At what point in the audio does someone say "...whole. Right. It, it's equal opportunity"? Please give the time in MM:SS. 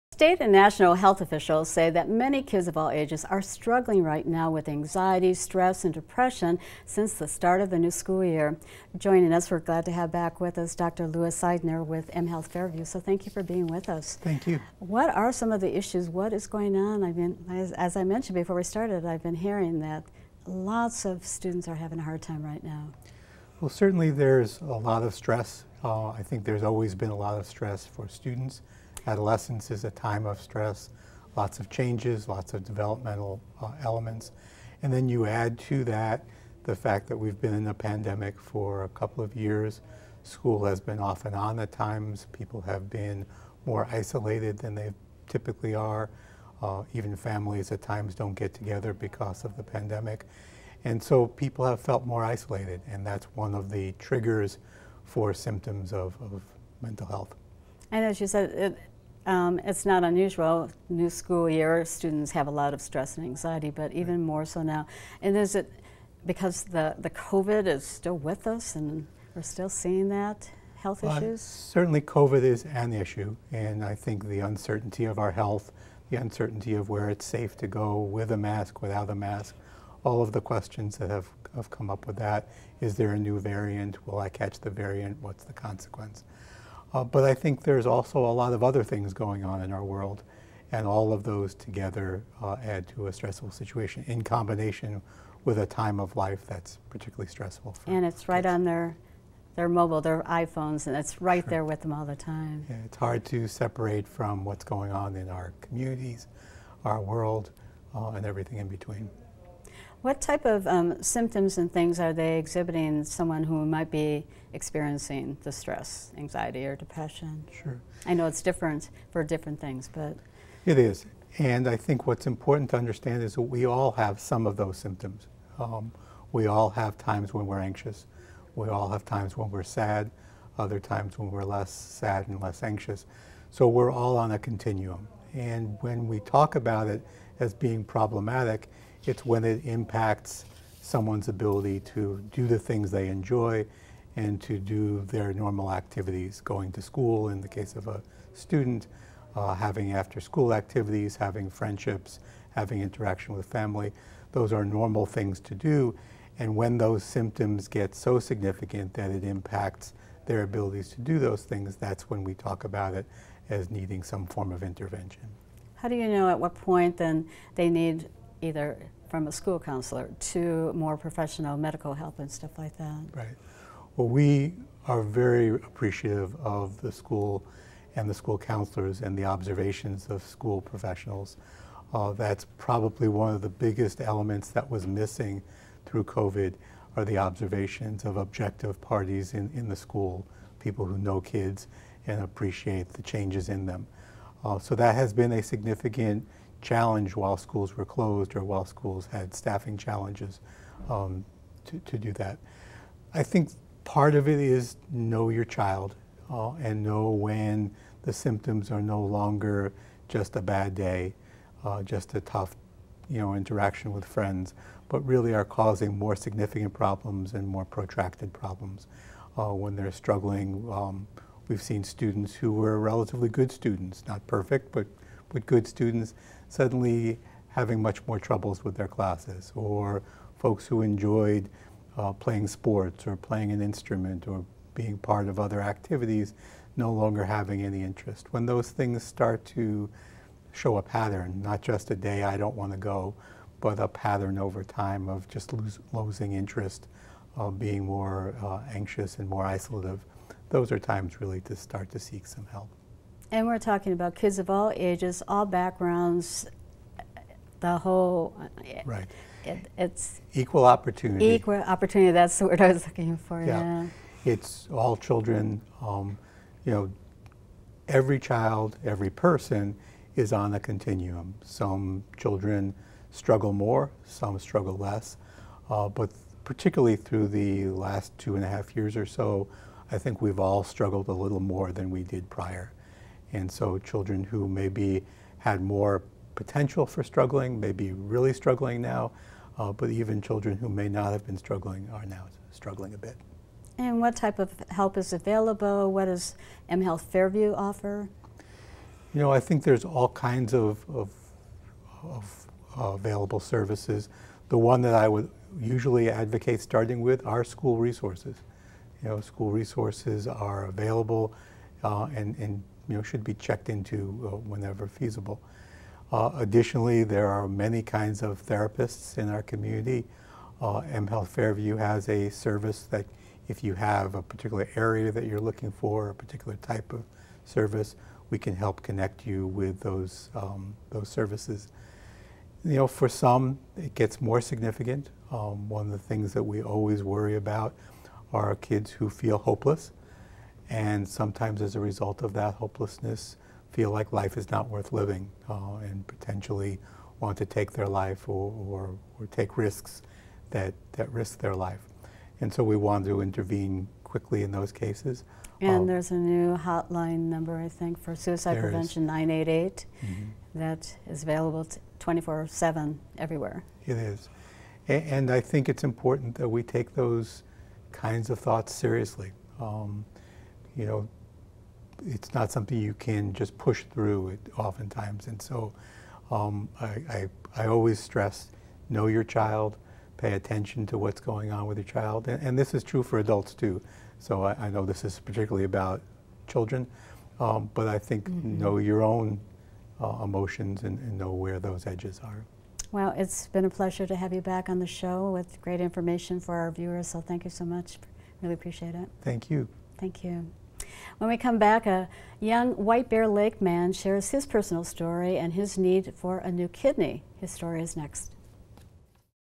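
04:17.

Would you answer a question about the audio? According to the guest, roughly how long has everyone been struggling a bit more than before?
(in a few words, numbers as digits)
2 and a half years.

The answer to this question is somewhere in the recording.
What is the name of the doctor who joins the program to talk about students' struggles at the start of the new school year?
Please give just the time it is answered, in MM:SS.
00:10.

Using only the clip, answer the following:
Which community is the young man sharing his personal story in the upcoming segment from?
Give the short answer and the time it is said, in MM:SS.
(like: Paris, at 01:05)
White Bear Lake, at 06:42.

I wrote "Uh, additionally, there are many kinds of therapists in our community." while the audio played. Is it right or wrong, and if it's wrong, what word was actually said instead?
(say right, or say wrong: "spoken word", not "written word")
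right.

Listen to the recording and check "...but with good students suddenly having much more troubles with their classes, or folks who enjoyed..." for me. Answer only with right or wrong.
right.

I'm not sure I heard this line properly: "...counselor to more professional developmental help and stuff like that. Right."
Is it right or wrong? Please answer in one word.
wrong.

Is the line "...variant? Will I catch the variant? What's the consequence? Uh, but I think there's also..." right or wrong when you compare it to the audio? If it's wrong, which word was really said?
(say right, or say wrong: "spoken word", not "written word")
right.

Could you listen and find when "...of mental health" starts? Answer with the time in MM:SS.
00:56.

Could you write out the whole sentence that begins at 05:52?
And so we want to intervene quickly in those cases.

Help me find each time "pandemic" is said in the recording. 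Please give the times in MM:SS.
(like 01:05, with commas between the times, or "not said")
00:37, 00:49.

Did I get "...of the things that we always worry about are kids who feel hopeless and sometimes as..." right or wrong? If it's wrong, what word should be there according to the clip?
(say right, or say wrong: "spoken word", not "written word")
right.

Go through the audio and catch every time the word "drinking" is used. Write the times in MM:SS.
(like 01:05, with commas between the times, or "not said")
not said.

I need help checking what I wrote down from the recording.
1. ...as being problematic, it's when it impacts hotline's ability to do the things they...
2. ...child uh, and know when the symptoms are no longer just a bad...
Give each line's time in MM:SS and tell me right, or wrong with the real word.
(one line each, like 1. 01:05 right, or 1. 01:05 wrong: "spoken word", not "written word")
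1. 02:17 wrong: "someone", not "hotline"
2. 03:25 right.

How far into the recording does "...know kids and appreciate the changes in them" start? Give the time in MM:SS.
03:10.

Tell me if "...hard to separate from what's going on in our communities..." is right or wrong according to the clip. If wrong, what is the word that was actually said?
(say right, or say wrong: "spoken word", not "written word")
right.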